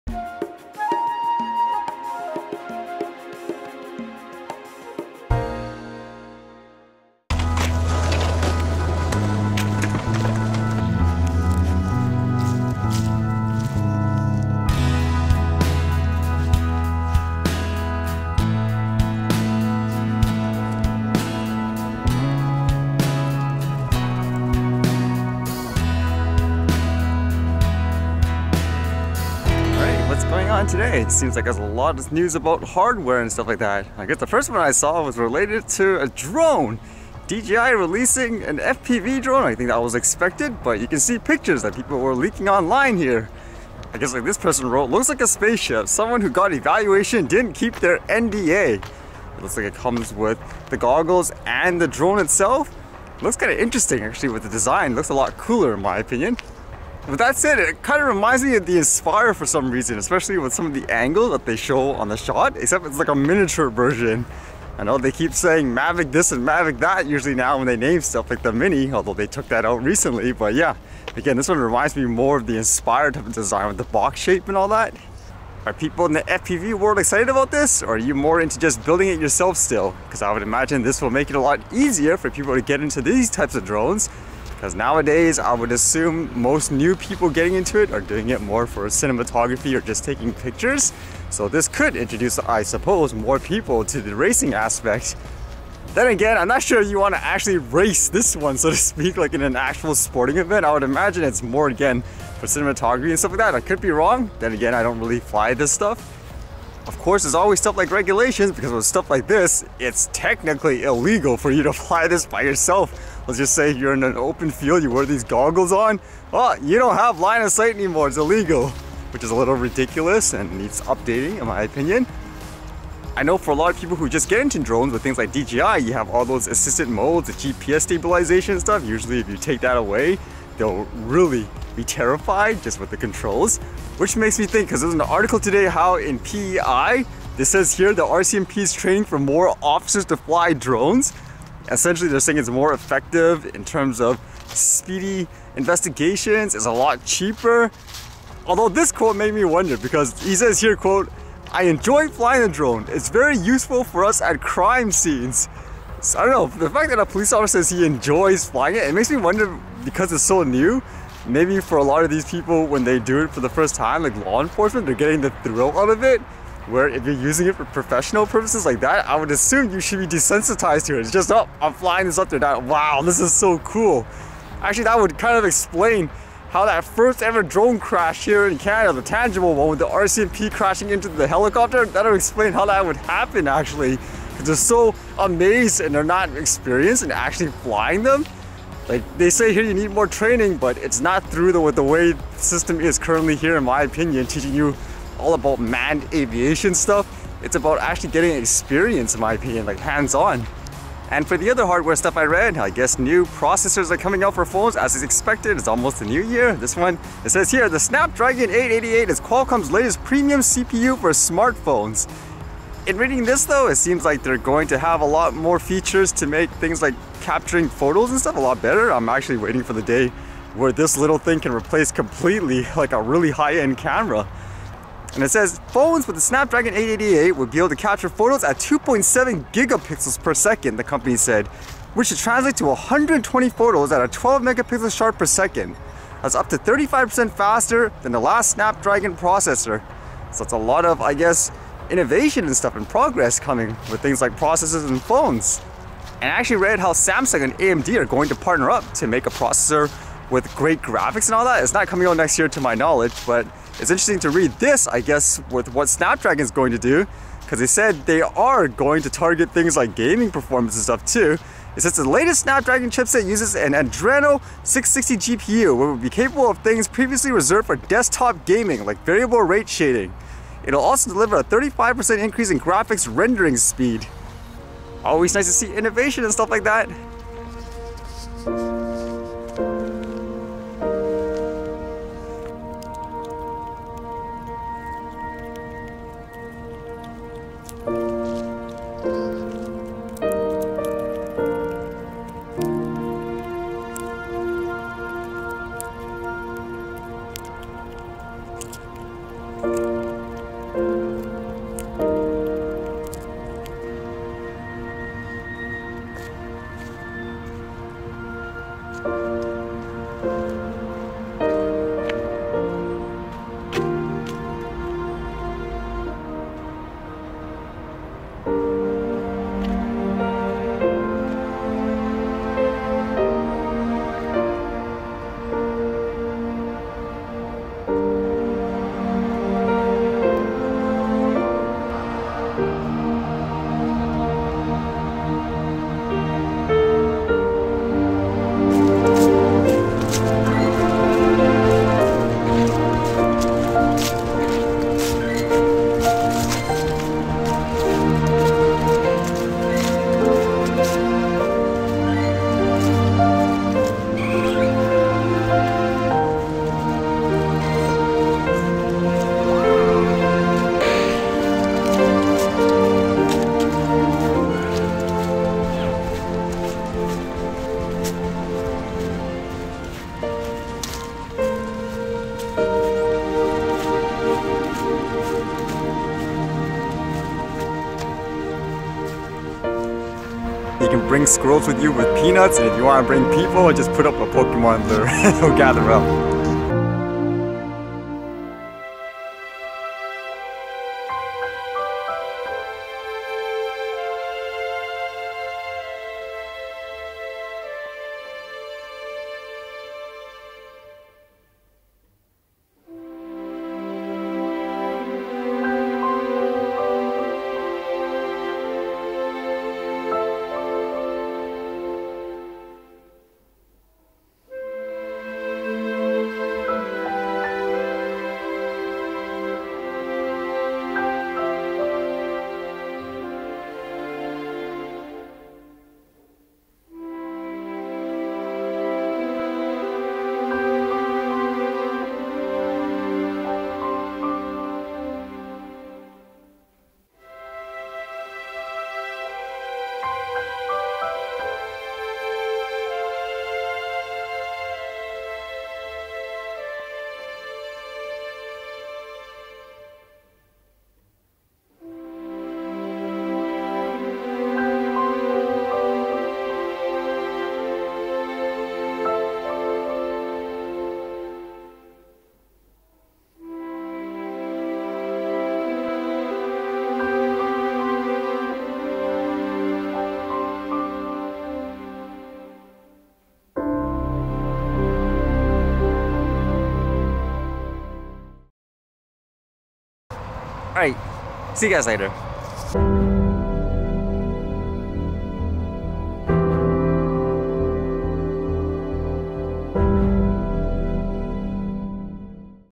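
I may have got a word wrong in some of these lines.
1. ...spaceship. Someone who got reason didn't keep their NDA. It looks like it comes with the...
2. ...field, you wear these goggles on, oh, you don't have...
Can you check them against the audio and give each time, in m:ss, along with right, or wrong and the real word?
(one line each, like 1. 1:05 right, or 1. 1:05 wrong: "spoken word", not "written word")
1. 0:45 wrong: "evaluation", not "reason"
2. 1:54 right.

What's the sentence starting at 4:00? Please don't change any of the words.
So it's a lot of, I guess, innovation and stuff and progress coming with things like processors and phones.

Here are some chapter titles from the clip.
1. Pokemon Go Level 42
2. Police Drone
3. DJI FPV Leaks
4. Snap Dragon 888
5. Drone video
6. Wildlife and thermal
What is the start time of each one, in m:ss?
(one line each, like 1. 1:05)
1. 5:39
2. 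2:13
3. 0:29
4. 3:20
5. 6:28
6. 4:37.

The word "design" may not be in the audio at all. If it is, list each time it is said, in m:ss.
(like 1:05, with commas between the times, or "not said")
0:54, 1:13.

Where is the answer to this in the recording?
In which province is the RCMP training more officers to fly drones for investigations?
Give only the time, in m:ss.
2:16.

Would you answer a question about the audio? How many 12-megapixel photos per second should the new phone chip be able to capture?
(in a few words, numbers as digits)
120.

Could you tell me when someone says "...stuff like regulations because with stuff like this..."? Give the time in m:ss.
1:47.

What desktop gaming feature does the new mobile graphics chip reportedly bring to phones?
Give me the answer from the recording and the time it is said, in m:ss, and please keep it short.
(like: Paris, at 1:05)
variable rate shading, at 4:29.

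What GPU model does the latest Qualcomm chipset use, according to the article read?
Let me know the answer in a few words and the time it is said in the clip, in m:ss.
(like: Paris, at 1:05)
Adreno 660, at 4:23.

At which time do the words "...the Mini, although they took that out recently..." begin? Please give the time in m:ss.
1:08.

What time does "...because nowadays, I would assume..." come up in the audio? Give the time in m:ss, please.
1:24.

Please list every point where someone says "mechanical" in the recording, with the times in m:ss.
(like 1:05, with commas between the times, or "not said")
not said.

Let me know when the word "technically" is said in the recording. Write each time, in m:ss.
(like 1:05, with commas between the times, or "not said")
1:50.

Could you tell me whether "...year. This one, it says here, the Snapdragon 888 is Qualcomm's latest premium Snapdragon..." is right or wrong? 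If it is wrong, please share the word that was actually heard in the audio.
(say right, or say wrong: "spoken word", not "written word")
wrong: "CPU", not "Snapdragon".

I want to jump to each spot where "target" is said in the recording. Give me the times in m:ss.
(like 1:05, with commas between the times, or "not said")
4:19.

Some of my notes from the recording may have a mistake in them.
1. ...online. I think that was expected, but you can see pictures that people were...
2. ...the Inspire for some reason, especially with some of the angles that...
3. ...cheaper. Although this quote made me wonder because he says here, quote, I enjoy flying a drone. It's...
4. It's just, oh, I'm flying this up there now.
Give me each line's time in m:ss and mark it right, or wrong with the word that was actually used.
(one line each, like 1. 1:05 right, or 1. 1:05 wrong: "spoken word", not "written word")
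1. 0:39 wrong: "drone", not "online"
2. 0:58 right
3. 2:27 right
4. 2:51 right.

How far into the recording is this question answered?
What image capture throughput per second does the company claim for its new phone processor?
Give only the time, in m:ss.
3:48.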